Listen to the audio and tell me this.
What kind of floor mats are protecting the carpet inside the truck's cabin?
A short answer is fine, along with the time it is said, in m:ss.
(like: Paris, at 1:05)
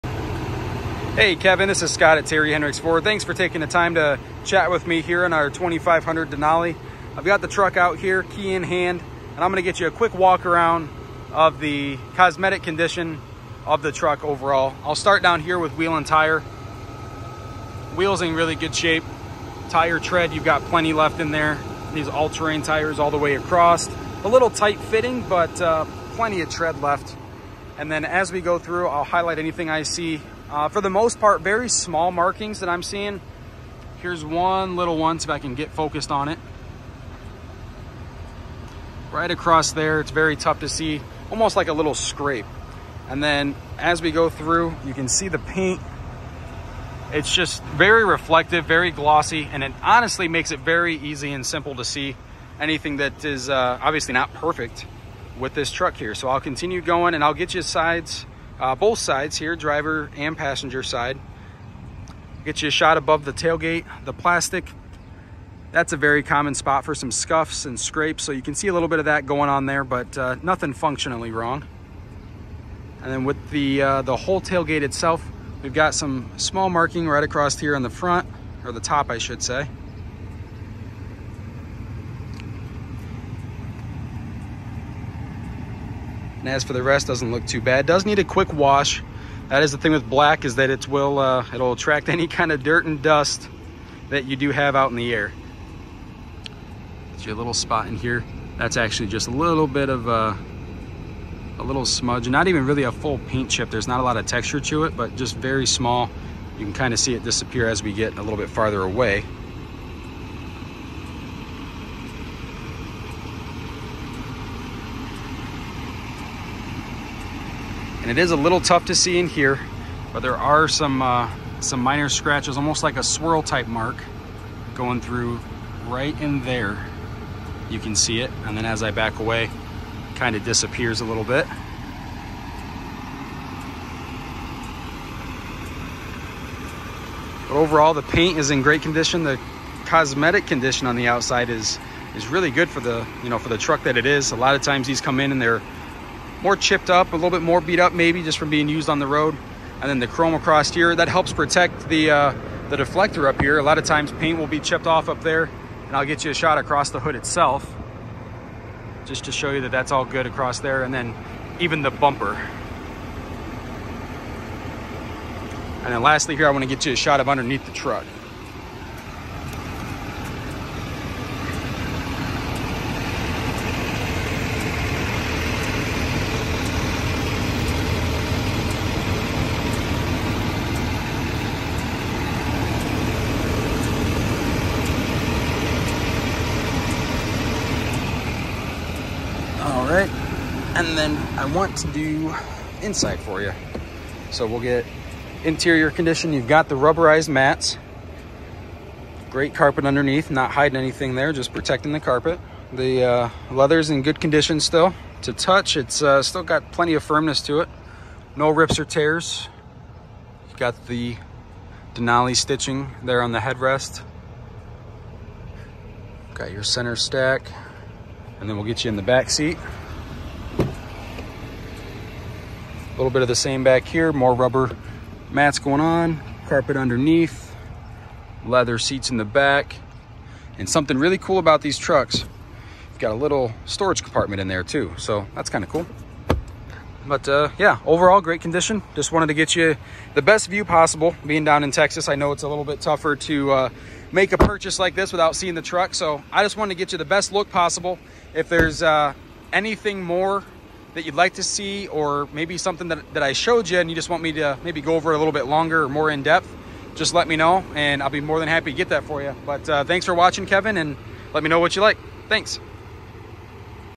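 Rubberized mats, at 3:16.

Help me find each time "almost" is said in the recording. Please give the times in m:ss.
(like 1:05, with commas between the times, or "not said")
0:41, 2:02.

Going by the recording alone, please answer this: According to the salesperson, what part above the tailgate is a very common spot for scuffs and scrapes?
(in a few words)
The plastic.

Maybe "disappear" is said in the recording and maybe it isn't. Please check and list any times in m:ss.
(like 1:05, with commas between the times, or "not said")
1:47, 2:10.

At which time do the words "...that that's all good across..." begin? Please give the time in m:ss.
2:39.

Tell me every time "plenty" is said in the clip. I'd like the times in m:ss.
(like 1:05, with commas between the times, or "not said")
0:20, 0:26, 3:26.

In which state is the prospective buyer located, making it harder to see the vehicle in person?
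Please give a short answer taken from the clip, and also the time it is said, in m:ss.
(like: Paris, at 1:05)
Texas, at 4:01.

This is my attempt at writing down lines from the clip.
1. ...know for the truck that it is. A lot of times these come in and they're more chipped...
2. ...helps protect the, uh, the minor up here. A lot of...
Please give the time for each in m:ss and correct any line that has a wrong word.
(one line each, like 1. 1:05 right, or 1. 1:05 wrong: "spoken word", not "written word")
1. 2:23 right
2. 2:31 wrong: "deflector", not "minor".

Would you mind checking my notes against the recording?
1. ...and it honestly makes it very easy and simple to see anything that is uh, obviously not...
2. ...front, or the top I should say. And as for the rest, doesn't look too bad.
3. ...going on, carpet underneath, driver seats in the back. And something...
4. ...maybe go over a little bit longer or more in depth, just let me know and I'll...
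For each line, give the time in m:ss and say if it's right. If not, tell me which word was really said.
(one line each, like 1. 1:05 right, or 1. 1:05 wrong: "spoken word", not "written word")
1. 0:49 right
2. 1:17 right
3. 3:45 wrong: "leather", not "driver"
4. 4:14 right.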